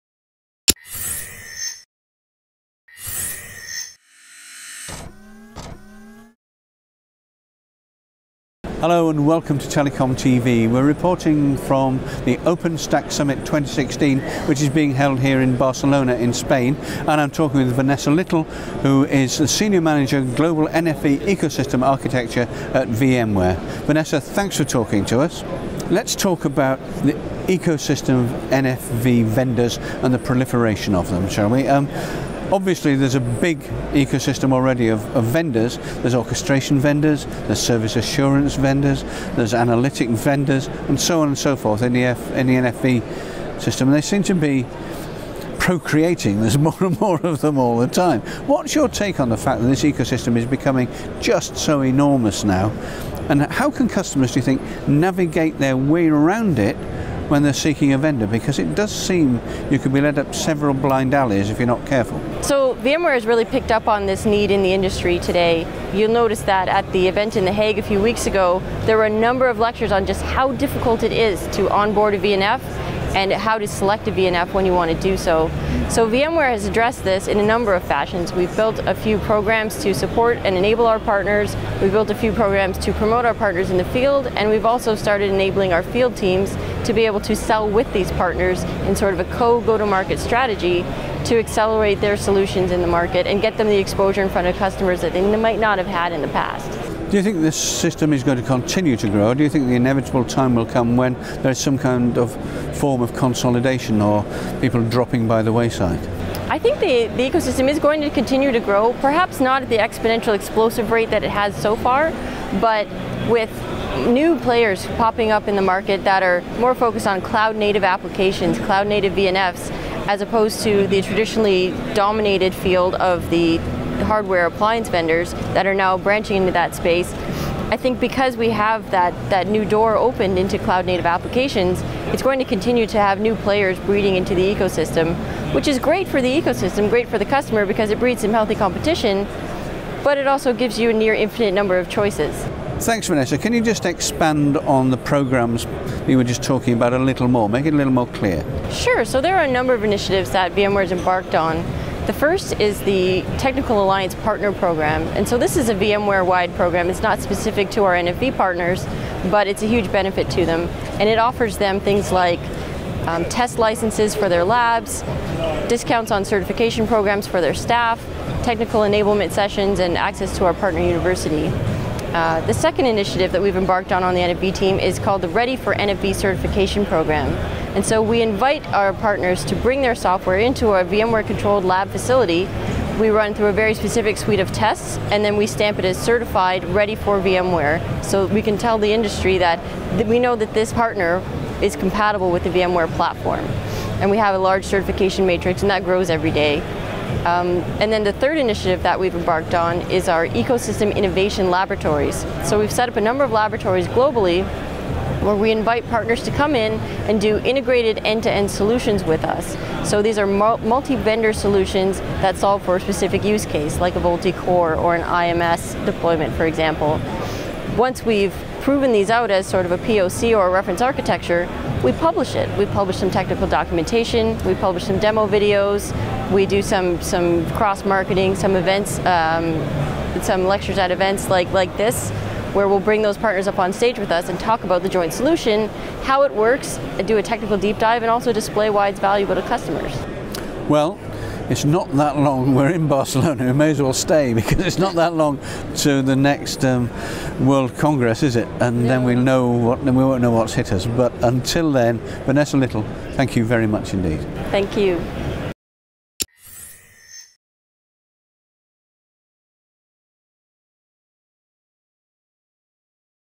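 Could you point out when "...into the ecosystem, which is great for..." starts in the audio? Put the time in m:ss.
2:14.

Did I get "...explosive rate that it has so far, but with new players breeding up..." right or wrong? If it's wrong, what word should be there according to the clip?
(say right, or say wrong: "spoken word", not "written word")
wrong: "popping", not "breeding".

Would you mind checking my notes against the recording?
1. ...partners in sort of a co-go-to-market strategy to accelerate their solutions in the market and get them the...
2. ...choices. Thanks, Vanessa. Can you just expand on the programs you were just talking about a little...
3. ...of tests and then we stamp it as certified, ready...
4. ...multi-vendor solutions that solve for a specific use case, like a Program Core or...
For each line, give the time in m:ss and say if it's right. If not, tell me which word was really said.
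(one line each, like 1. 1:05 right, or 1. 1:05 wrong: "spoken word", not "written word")
1. 1:28 right
2. 2:21 right
3. 3:04 right
4. 3:30 wrong: "VoLTE", not "Program".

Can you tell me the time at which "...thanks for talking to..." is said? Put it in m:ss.
0:24.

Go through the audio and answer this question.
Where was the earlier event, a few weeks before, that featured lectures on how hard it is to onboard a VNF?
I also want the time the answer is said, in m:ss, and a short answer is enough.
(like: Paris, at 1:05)
The Hague, at 1:07.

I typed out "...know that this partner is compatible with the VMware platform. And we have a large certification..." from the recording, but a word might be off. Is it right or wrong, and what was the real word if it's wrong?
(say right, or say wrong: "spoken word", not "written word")
right.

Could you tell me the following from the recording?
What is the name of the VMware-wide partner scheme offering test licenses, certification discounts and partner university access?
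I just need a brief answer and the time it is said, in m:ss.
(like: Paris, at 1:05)
Technical Alliance Partner Program, at 2:33.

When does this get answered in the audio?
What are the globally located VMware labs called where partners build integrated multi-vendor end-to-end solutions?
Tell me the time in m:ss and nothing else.
3:20.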